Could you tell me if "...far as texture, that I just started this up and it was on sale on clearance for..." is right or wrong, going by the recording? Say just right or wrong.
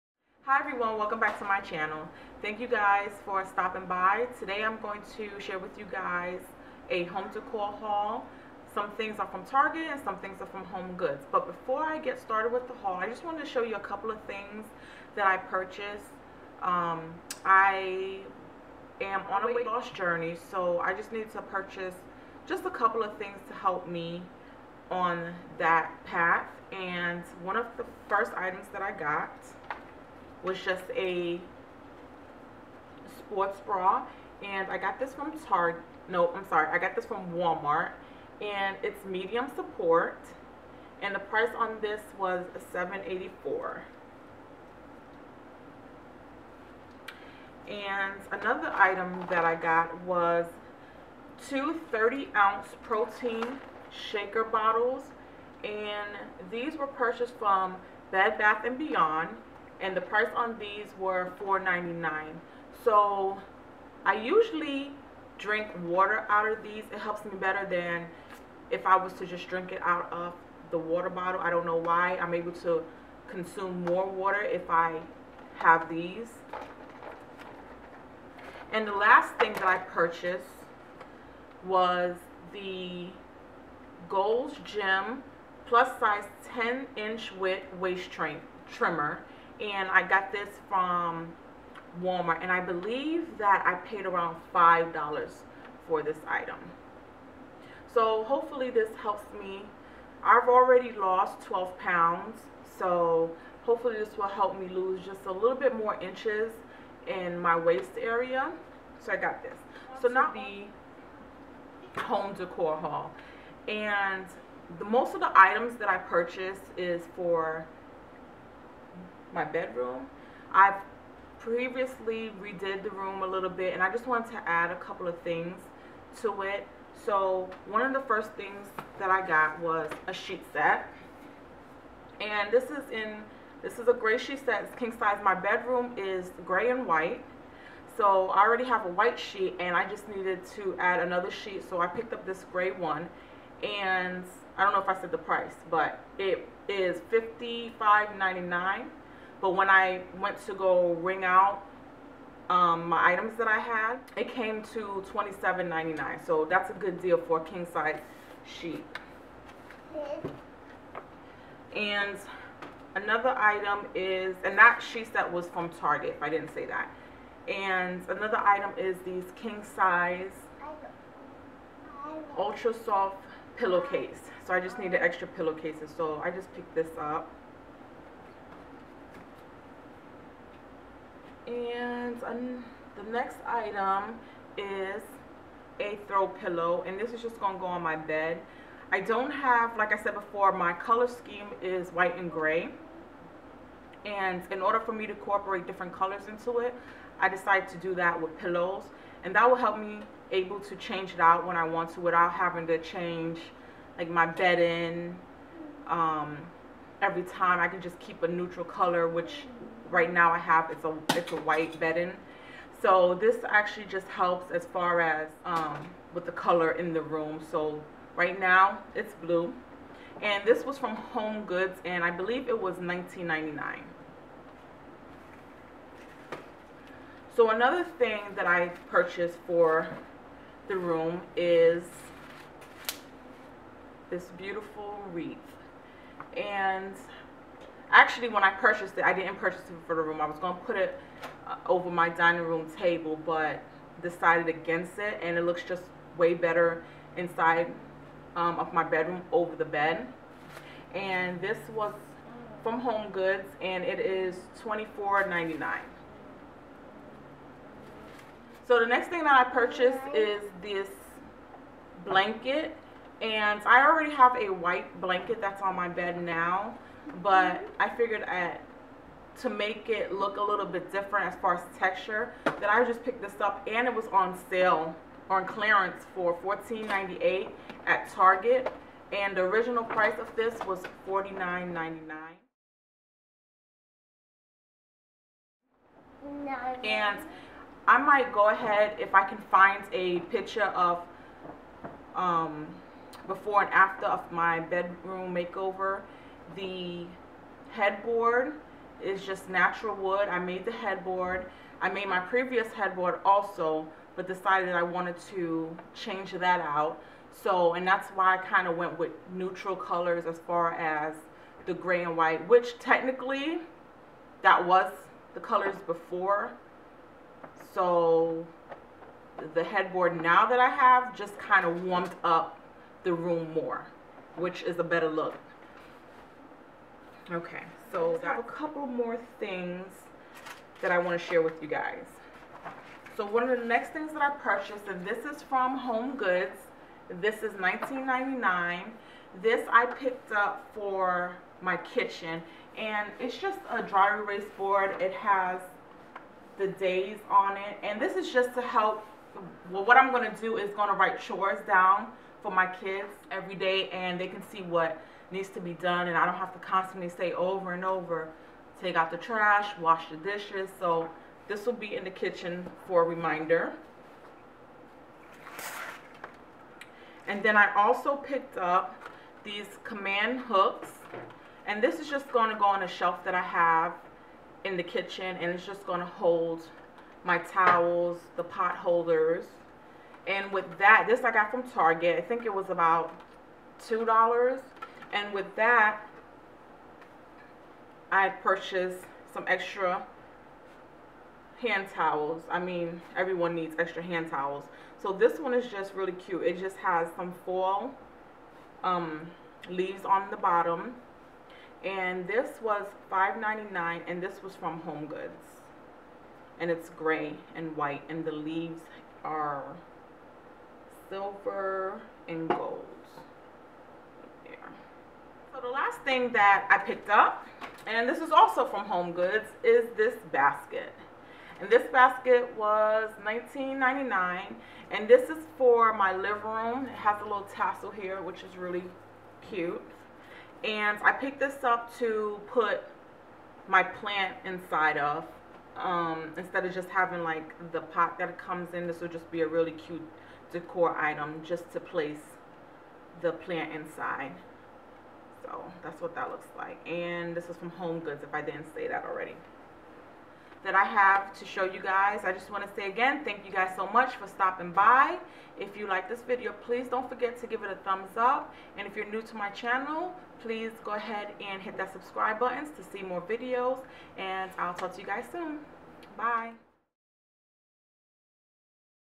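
wrong.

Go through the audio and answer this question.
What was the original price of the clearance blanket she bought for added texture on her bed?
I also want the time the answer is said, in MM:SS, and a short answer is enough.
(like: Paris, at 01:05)
$49.99, at 04:41.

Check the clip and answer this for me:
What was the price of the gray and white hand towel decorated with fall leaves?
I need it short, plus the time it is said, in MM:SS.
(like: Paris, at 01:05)
$5.99, at 06:43.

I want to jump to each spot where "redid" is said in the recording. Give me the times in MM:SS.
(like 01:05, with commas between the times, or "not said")
02:02.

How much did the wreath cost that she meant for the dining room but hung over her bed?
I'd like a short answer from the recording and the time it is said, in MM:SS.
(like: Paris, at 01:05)
$24.99, at 04:14.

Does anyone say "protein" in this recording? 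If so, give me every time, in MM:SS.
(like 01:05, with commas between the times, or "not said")
00:52.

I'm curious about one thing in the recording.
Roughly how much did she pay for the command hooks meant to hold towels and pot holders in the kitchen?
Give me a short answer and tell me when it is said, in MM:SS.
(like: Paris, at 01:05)
$2, at 06:23.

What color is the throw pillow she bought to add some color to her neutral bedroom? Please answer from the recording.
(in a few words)
Blue.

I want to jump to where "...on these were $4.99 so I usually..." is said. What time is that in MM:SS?
01:00.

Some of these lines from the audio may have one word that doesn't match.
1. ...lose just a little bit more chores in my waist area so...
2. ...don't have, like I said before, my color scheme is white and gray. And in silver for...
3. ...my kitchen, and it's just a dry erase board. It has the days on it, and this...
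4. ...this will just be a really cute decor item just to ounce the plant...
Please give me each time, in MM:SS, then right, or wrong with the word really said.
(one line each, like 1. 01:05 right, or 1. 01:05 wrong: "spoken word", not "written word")
1. 01:44 wrong: "inches", not "chores"
2. 03:08 wrong: "order", not "silver"
3. 05:41 right
4. 07:18 wrong: "place", not "ounce".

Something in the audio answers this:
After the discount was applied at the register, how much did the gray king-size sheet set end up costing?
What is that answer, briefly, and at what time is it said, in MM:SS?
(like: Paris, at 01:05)
$27.99, at 02:35.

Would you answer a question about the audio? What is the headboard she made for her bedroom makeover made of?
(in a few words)
Natural wood.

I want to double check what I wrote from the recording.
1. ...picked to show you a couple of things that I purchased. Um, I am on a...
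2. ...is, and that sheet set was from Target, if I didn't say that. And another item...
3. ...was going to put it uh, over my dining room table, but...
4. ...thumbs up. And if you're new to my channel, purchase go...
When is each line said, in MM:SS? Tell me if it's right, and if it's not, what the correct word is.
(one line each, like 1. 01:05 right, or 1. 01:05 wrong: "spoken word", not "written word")
1. 00:13 wrong: "wanted", not "picked"
2. 02:43 right
3. 04:00 right
4. 07:37 wrong: "please", not "purchase".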